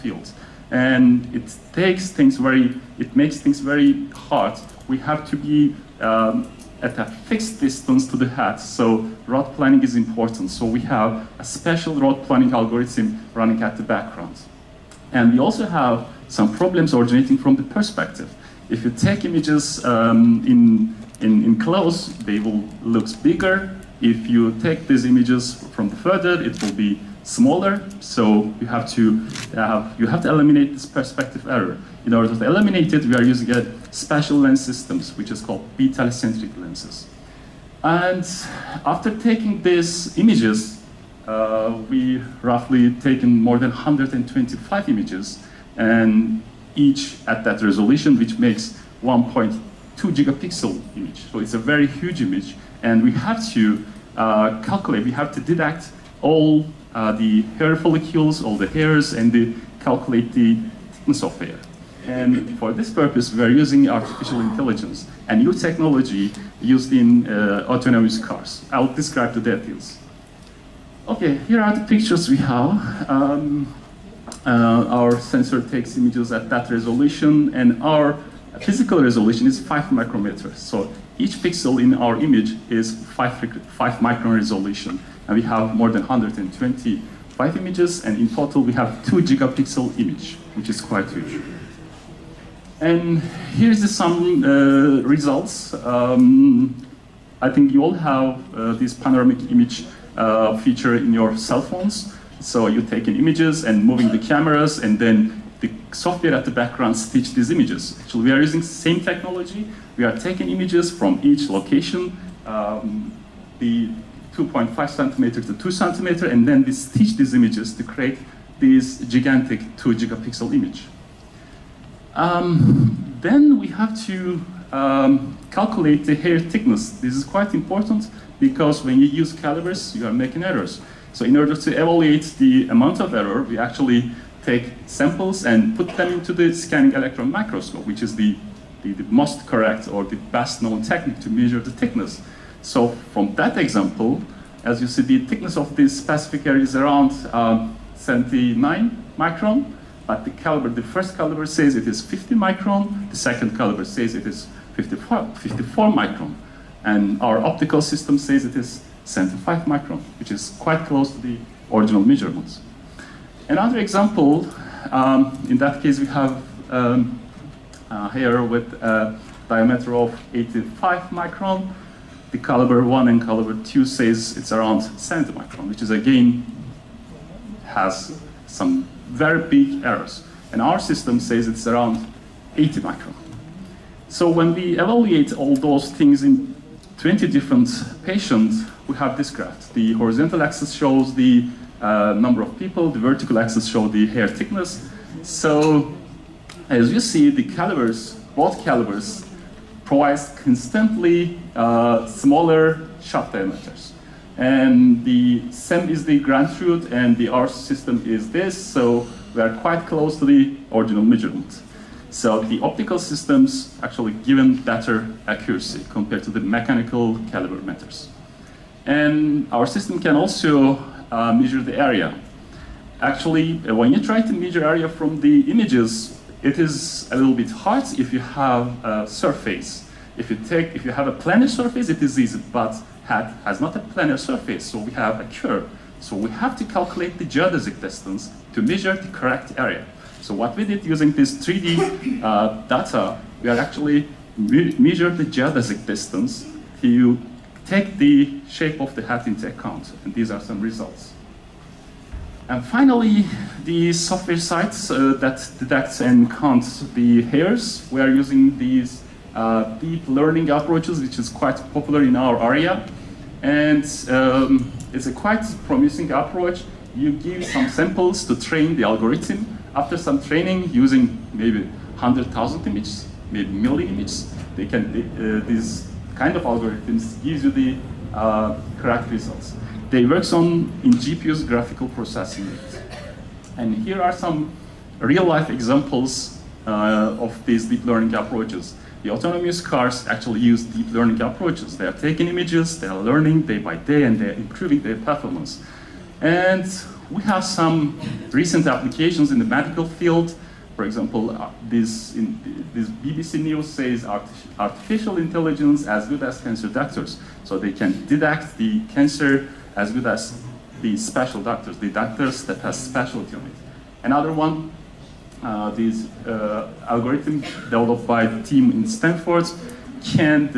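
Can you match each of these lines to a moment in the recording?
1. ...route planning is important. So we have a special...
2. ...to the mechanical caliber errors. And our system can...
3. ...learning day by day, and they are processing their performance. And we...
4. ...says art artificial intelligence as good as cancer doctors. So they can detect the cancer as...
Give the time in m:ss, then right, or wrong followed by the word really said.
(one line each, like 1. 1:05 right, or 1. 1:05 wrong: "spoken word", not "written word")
1. 0:09 right
2. 3:36 wrong: "meters", not "errors"
3. 4:53 wrong: "improving", not "processing"
4. 5:03 right.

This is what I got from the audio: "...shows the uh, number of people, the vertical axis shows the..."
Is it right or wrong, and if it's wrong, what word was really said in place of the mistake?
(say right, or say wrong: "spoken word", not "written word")
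right.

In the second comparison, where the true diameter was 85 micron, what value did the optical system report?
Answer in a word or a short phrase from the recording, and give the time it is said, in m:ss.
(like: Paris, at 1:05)
80 micron, at 3:02.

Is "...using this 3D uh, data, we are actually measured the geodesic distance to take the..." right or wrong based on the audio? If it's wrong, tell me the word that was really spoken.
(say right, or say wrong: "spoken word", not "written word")
right.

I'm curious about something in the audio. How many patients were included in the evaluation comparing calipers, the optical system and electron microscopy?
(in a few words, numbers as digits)
20.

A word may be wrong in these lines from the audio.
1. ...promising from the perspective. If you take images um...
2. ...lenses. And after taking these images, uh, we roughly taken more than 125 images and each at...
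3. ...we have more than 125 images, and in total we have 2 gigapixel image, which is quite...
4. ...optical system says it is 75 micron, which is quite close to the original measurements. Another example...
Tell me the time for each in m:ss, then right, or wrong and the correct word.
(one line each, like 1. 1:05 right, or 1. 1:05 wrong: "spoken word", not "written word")
1. 0:16 wrong: "originating", not "promising"
2. 0:36 right
3. 1:25 right
4. 2:37 right.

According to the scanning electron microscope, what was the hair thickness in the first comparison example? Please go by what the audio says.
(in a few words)
79 micron.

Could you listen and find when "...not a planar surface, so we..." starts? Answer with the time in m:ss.
3:53.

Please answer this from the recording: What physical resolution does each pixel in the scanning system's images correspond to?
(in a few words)
5 micrometers.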